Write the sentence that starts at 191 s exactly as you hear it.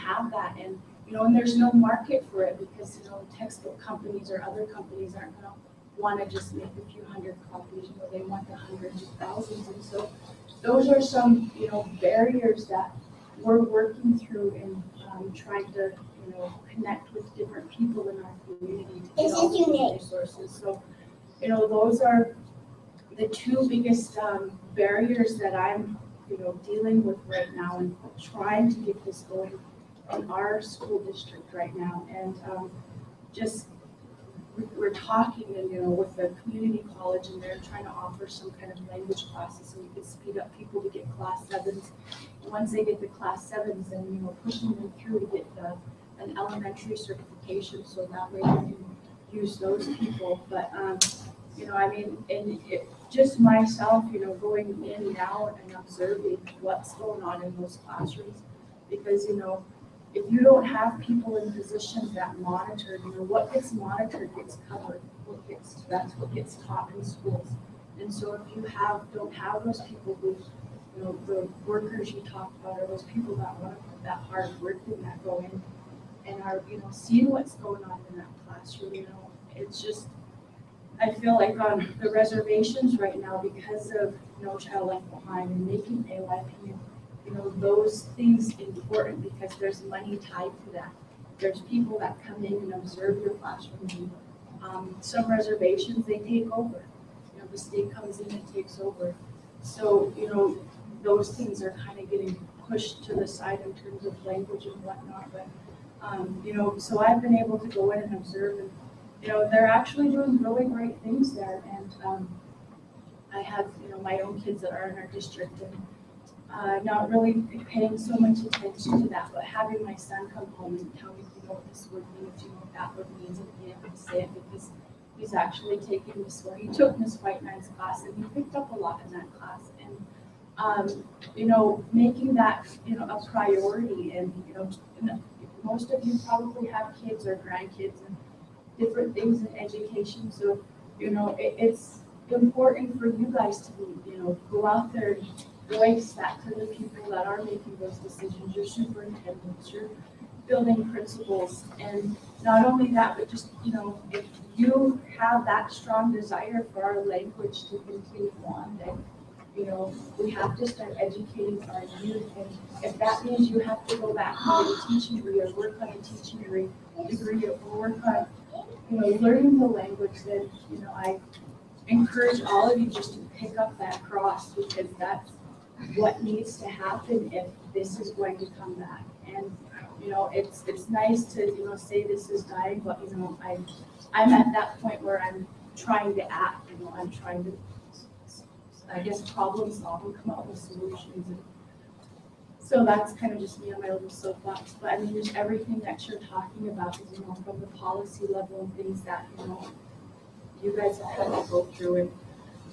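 And, so that's kind of just me on my little soapbox.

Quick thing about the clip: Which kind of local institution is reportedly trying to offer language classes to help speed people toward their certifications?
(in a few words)
community college.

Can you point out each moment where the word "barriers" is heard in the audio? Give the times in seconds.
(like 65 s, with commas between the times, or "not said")
12 s, 24 s.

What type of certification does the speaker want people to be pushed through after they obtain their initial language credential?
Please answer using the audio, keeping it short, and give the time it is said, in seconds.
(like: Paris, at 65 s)
elementary certification, at 46 s.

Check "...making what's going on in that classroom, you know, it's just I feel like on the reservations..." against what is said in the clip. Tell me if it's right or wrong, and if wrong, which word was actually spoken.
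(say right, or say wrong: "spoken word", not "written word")
wrong: "seeing", not "making".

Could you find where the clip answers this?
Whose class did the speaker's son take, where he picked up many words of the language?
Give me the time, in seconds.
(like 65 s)
126 s.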